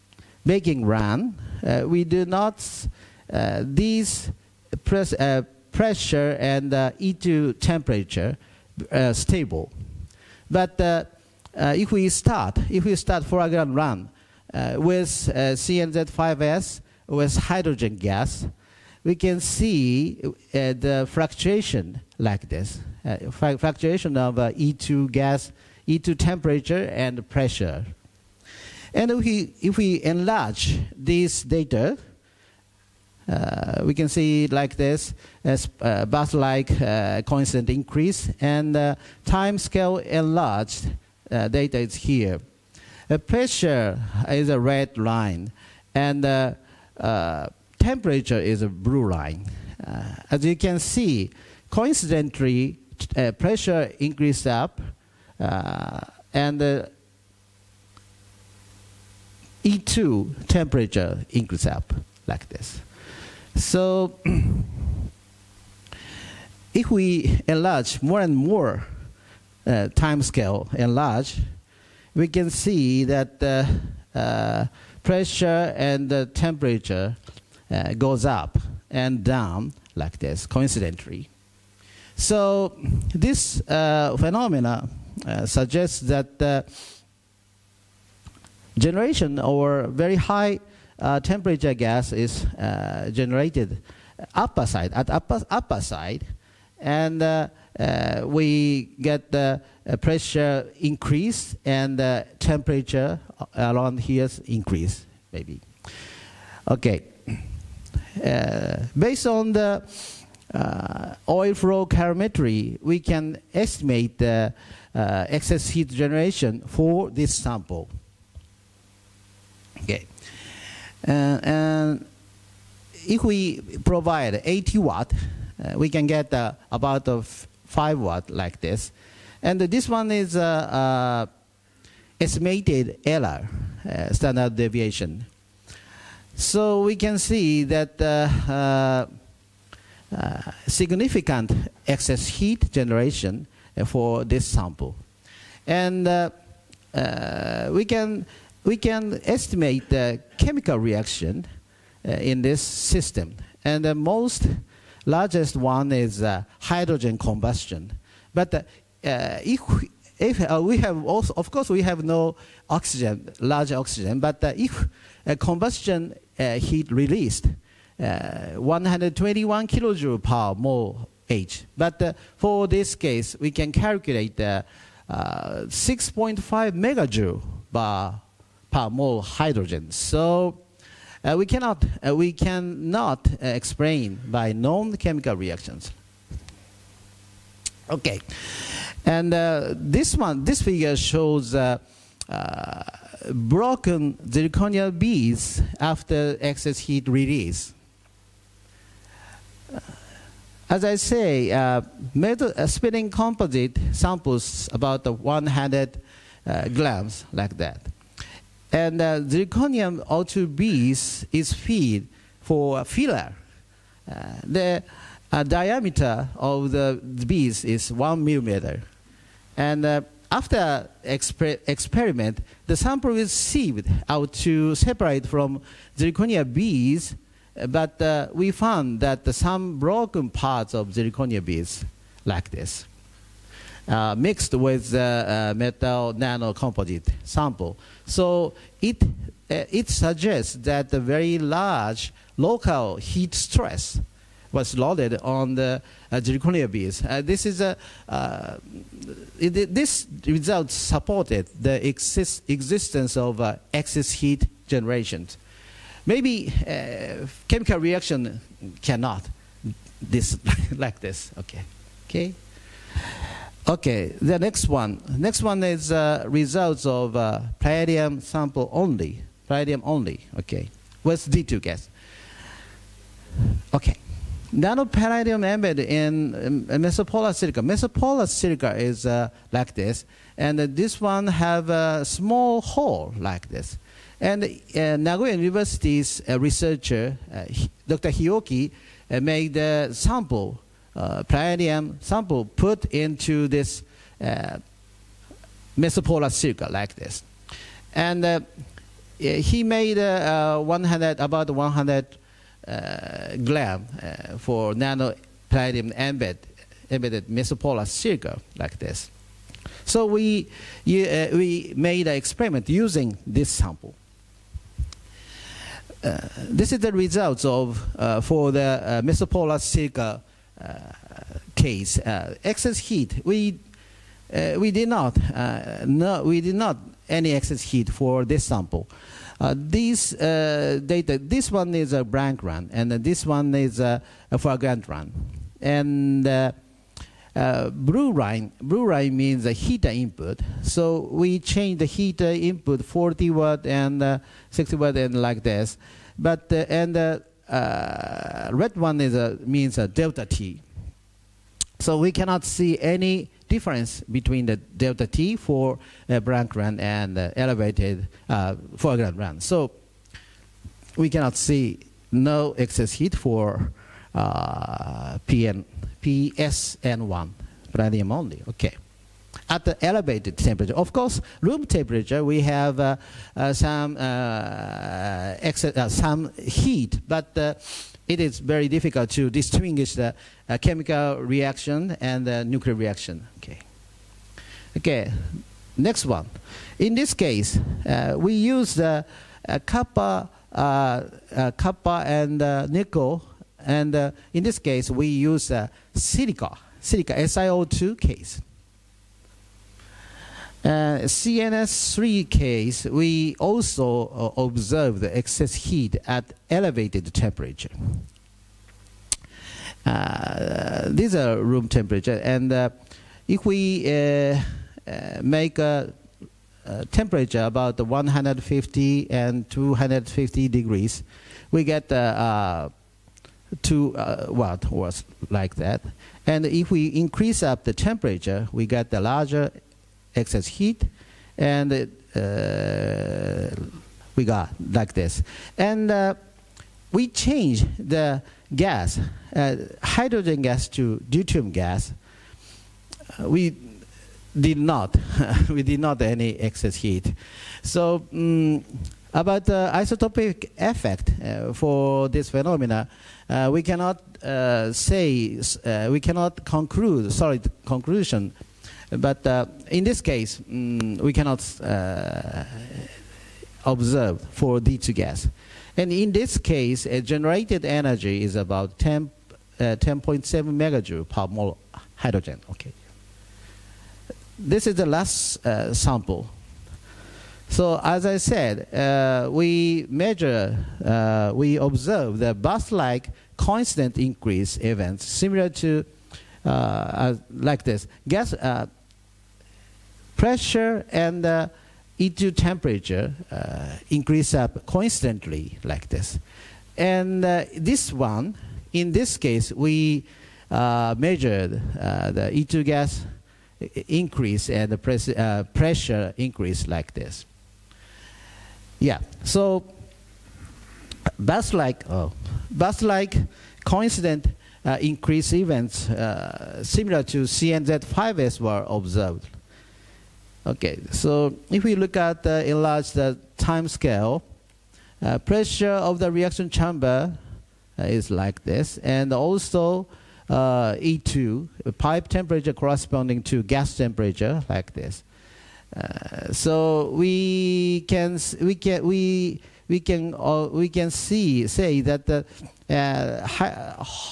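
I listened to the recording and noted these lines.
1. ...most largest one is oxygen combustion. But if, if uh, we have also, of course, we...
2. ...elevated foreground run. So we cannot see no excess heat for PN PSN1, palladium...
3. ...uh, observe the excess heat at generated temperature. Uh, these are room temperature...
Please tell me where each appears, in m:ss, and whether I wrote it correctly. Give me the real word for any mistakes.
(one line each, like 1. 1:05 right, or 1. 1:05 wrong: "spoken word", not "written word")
1. 2:33 wrong: "hydrogen", not "oxygen"
2. 5:57 right
3. 6:44 wrong: "elevated", not "generated".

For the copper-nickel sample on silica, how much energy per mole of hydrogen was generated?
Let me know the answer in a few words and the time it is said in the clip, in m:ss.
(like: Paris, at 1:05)
10.7 MJ/mol, at 7:49.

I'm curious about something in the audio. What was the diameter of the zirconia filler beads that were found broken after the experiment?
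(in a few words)
1 millimeter.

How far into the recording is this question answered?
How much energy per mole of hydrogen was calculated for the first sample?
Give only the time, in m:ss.
2:55.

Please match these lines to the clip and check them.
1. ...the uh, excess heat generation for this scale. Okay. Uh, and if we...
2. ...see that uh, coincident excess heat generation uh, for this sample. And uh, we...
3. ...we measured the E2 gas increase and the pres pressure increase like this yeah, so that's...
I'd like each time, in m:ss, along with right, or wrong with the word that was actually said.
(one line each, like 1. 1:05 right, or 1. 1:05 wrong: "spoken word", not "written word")
1. 1:54 wrong: "sample", not "scale"
2. 2:17 wrong: "significant", not "coincident"
3. 8:19 right.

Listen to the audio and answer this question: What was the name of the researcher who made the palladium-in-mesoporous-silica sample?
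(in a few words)
Dr. Hioki.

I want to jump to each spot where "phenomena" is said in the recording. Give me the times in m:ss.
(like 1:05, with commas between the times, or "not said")
1:23, 7:32.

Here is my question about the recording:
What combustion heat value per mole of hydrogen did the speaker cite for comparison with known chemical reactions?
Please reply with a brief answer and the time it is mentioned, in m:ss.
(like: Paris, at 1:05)
121 kJ/mol, at 2:48.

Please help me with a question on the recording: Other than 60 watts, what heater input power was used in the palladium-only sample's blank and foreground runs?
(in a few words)
40 watts.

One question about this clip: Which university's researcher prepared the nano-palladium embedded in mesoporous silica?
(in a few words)
Nagoya University.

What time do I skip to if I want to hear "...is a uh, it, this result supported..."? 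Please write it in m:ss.
4:07.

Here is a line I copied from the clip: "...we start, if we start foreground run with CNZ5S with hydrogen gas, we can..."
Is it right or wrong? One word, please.
right.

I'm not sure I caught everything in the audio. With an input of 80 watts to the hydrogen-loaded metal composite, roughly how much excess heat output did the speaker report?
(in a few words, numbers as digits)
5 watts.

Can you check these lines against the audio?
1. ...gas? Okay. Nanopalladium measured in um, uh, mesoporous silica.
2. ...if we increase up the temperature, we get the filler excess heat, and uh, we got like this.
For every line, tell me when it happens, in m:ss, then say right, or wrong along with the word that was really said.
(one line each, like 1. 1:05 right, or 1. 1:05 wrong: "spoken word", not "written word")
1. 4:31 wrong: "embedded", not "measured"
2. 7:06 wrong: "larger", not "filler".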